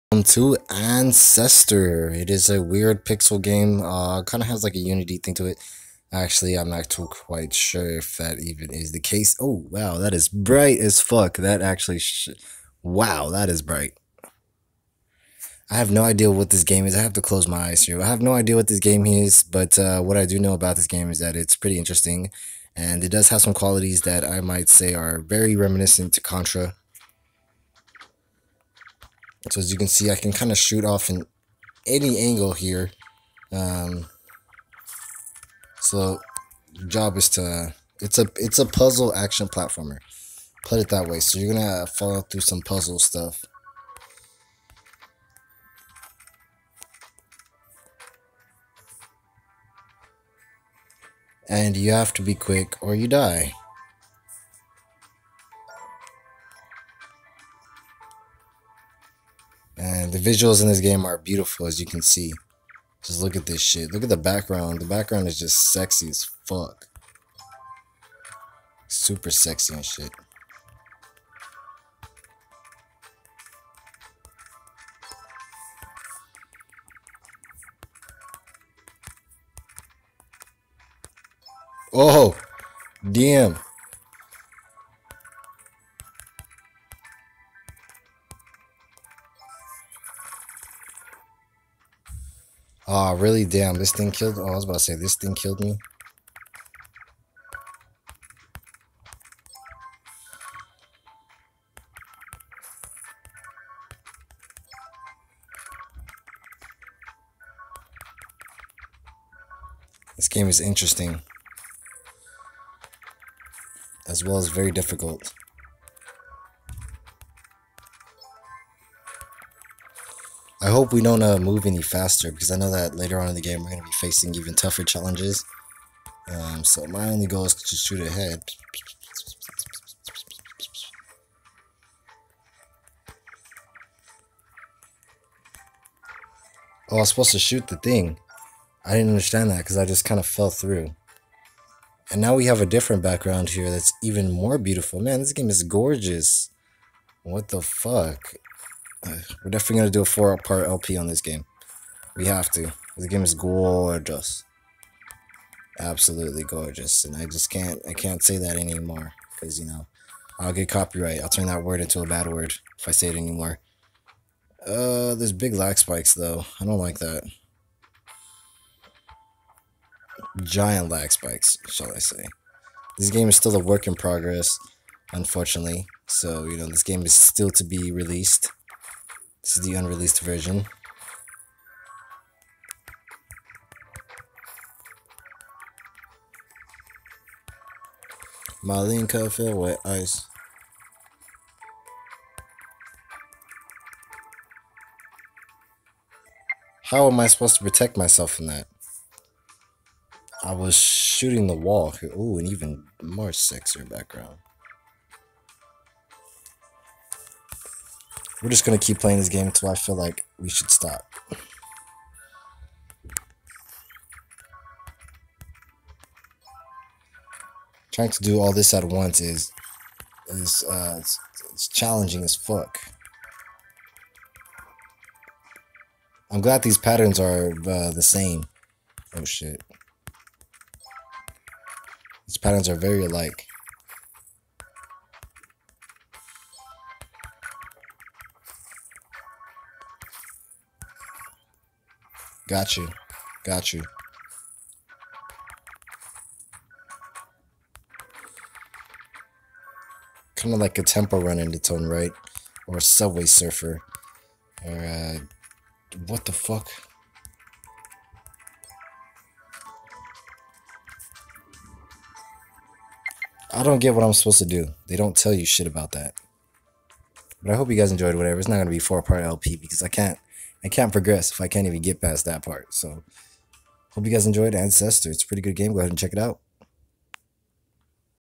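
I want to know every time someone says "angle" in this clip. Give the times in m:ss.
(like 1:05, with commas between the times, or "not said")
0:32.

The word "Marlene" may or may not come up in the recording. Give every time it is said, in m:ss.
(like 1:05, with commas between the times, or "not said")
3:08.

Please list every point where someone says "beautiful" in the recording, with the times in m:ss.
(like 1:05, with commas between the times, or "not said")
1:01, 2:24.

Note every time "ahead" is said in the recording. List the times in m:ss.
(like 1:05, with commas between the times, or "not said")
2:07, 4:35.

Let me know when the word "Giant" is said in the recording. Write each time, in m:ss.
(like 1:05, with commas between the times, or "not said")
2:50.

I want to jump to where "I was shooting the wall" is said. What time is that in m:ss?
3:20.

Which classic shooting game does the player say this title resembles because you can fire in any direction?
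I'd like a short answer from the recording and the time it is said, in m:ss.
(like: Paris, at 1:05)
Contra, at 0:26.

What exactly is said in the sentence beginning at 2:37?
And I just can't I can't say that anymore.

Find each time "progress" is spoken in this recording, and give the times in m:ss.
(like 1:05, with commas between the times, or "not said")
2:53, 4:30.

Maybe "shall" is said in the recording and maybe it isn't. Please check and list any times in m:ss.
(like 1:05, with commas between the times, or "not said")
2:51.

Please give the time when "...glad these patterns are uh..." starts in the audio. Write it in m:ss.
3:46.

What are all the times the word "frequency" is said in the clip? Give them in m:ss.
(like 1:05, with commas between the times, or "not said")
not said.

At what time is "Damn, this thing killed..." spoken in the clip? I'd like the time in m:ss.
1:33.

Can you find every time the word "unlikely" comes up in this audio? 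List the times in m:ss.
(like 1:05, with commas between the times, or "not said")
not said.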